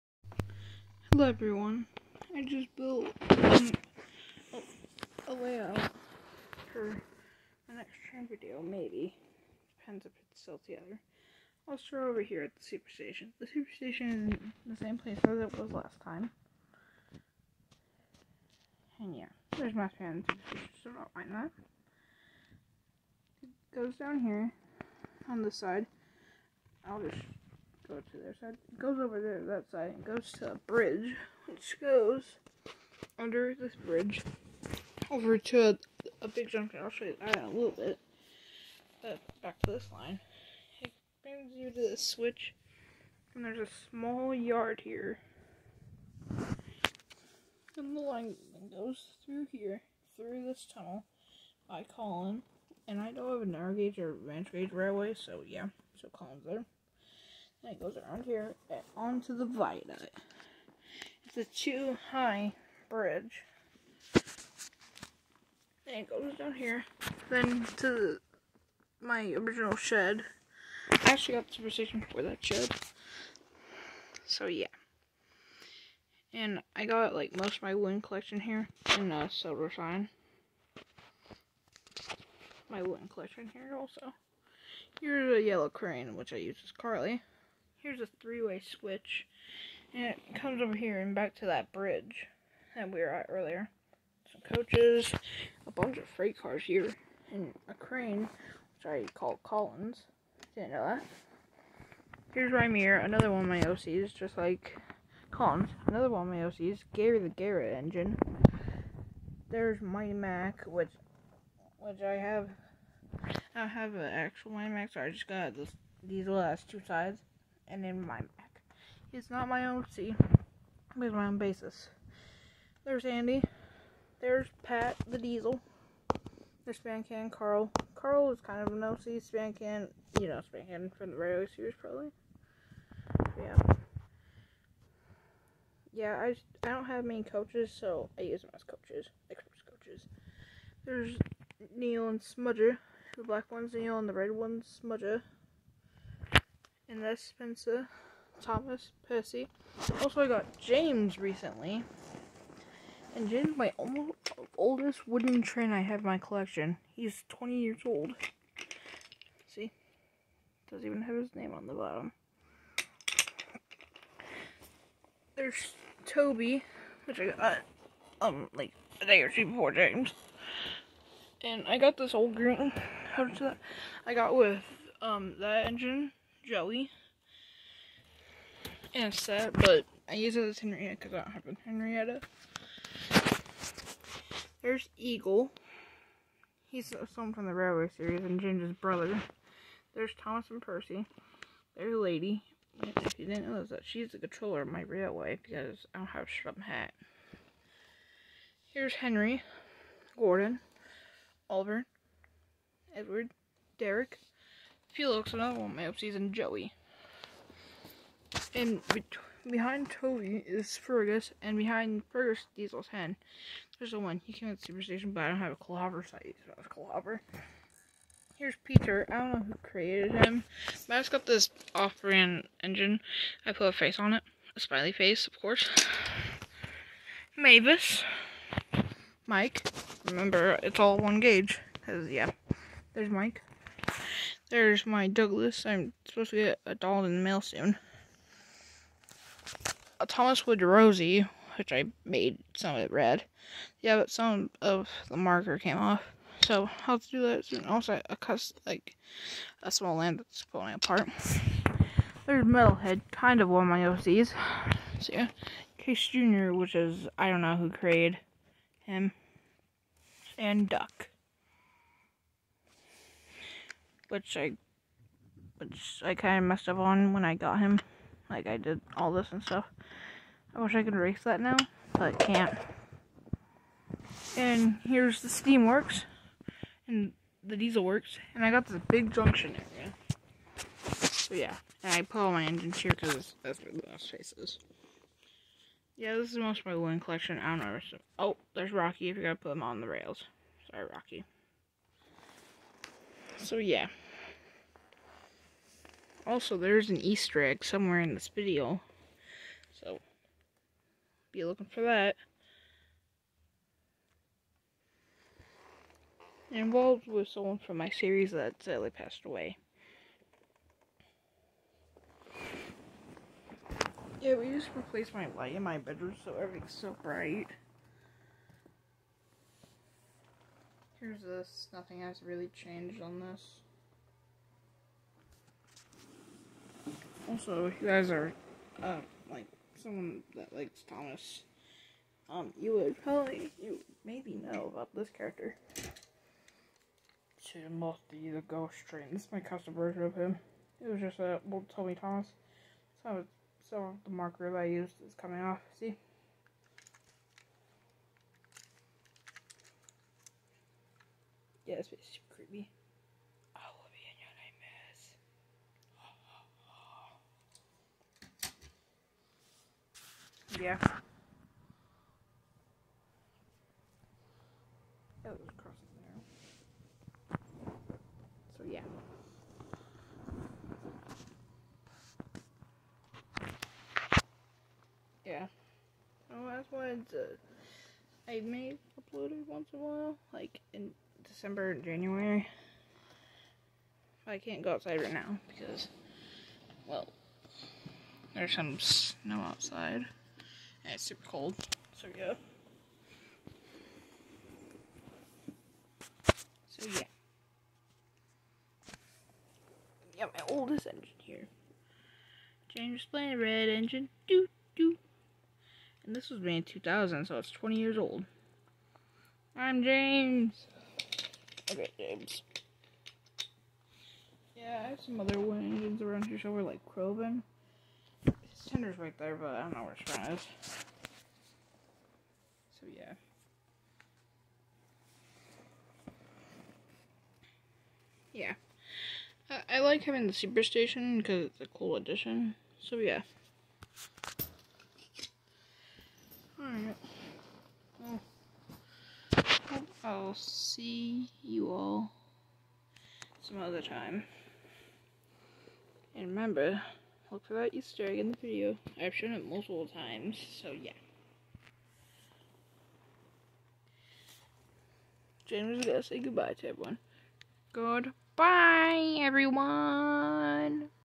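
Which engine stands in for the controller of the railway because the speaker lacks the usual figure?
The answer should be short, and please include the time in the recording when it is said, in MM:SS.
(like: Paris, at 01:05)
Lady, at 03:11.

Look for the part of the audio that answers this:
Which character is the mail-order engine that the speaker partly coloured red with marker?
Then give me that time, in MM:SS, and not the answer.
04:00.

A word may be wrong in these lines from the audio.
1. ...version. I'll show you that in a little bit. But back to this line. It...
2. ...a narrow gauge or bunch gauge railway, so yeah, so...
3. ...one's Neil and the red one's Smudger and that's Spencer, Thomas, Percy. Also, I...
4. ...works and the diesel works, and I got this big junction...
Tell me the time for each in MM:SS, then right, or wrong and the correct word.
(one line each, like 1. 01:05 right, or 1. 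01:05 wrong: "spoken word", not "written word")
1. 00:36 wrong: "junction", not "version"
2. 00:53 wrong: "ranch", not "bunch"
3. 02:23 right
4. 04:35 right.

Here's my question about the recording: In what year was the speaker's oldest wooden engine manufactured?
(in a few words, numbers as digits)
2000.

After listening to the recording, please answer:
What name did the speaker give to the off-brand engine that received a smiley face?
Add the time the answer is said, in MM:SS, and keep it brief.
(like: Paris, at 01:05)
Peter, at 03:38.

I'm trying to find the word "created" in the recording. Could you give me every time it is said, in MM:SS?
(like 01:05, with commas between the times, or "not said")
03:39, 04:17.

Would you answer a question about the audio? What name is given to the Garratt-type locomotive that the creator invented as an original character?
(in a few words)
Gary.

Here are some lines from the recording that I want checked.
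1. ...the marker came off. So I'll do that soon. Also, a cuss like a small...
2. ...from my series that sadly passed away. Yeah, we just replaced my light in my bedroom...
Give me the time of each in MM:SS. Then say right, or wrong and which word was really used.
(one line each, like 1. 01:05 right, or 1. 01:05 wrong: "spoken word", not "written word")
1. 04:05 right
2. 05:07 right.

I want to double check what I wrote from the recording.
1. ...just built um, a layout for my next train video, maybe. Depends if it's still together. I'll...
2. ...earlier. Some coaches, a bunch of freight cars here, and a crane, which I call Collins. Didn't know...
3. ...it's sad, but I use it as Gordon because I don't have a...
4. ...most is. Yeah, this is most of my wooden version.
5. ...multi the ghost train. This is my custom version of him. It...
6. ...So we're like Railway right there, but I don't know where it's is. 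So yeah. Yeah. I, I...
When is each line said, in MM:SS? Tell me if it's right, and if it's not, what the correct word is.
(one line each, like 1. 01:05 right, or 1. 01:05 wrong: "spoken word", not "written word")
1. 00:02 right
2. 01:33 right
3. 02:59 wrong: "Henrietta", not "Gordon"
4. 04:43 wrong: "collection", not "version"
5. 05:37 right
6. 06:56 wrong: "Crowbin", not "Railway".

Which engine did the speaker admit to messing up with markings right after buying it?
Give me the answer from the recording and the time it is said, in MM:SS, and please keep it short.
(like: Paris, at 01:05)
Duck, at 04:20.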